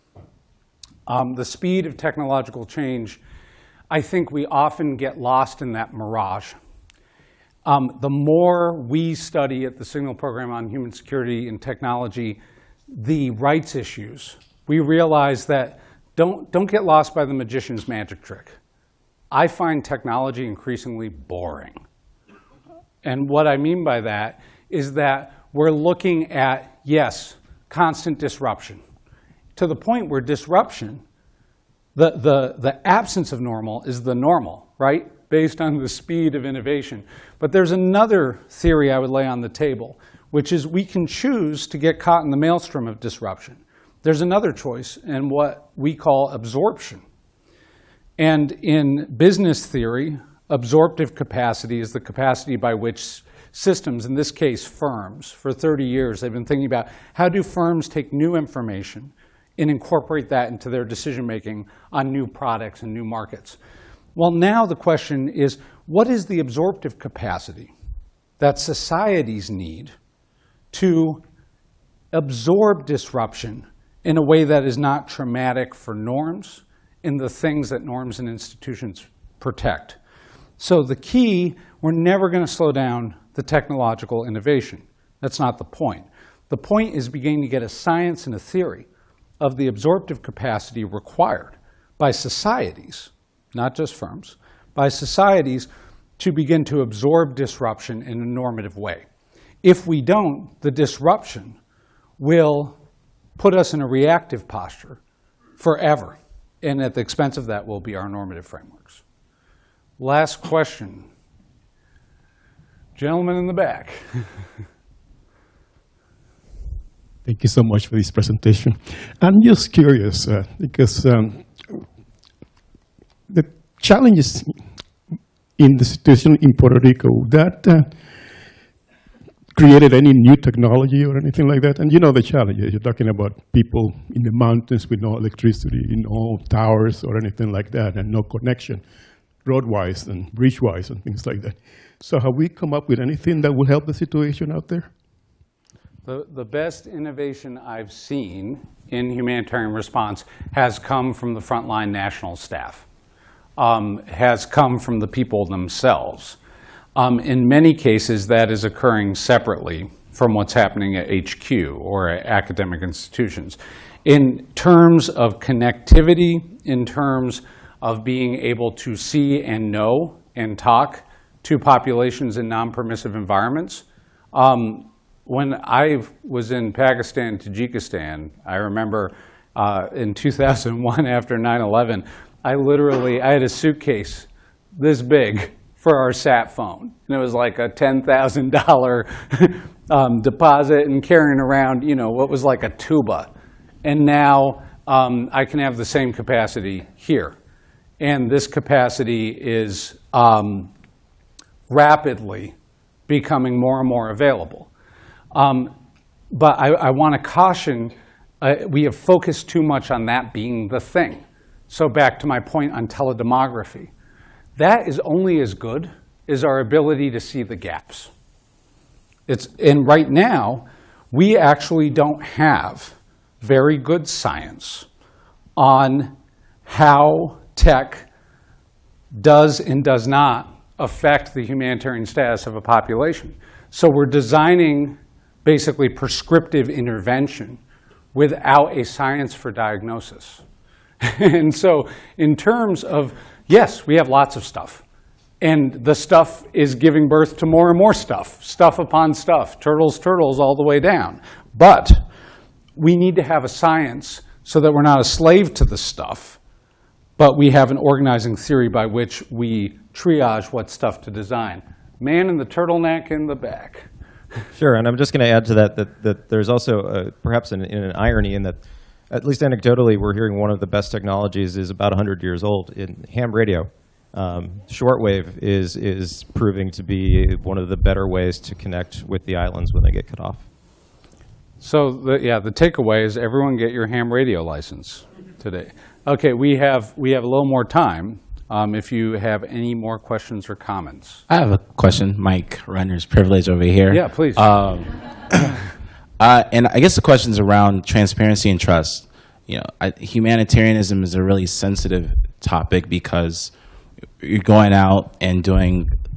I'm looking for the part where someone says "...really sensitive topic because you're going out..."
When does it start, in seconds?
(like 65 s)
301 s.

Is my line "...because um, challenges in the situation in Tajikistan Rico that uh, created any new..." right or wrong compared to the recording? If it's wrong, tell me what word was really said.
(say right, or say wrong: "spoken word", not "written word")
wrong: "Puerto", not "Tajikistan".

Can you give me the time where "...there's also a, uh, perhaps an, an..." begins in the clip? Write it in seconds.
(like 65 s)
266 s.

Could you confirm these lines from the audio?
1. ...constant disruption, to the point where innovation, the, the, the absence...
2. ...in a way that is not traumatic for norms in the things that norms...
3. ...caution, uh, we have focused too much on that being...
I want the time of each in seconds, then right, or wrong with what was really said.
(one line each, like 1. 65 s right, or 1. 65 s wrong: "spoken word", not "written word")
1. 27 s wrong: "disruption", not "innovation"
2. 74 s right
3. 207 s right.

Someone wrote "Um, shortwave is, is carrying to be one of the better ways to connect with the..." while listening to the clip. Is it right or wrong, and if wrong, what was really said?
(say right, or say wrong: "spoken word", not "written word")
wrong: "proving", not "carrying".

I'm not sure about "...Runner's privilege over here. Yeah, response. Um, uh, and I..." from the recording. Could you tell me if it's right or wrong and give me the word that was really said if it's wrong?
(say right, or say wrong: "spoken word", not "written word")
wrong: "please", not "response".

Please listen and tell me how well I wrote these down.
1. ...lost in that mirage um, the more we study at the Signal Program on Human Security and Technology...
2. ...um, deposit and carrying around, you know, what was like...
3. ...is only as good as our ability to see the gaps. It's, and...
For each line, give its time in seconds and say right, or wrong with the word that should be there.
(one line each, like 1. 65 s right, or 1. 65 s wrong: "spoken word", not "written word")
1. 5 s right
2. 189 s right
3. 214 s right.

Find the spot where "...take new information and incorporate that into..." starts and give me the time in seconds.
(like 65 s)
57 s.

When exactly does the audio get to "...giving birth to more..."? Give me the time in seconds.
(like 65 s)
246 s.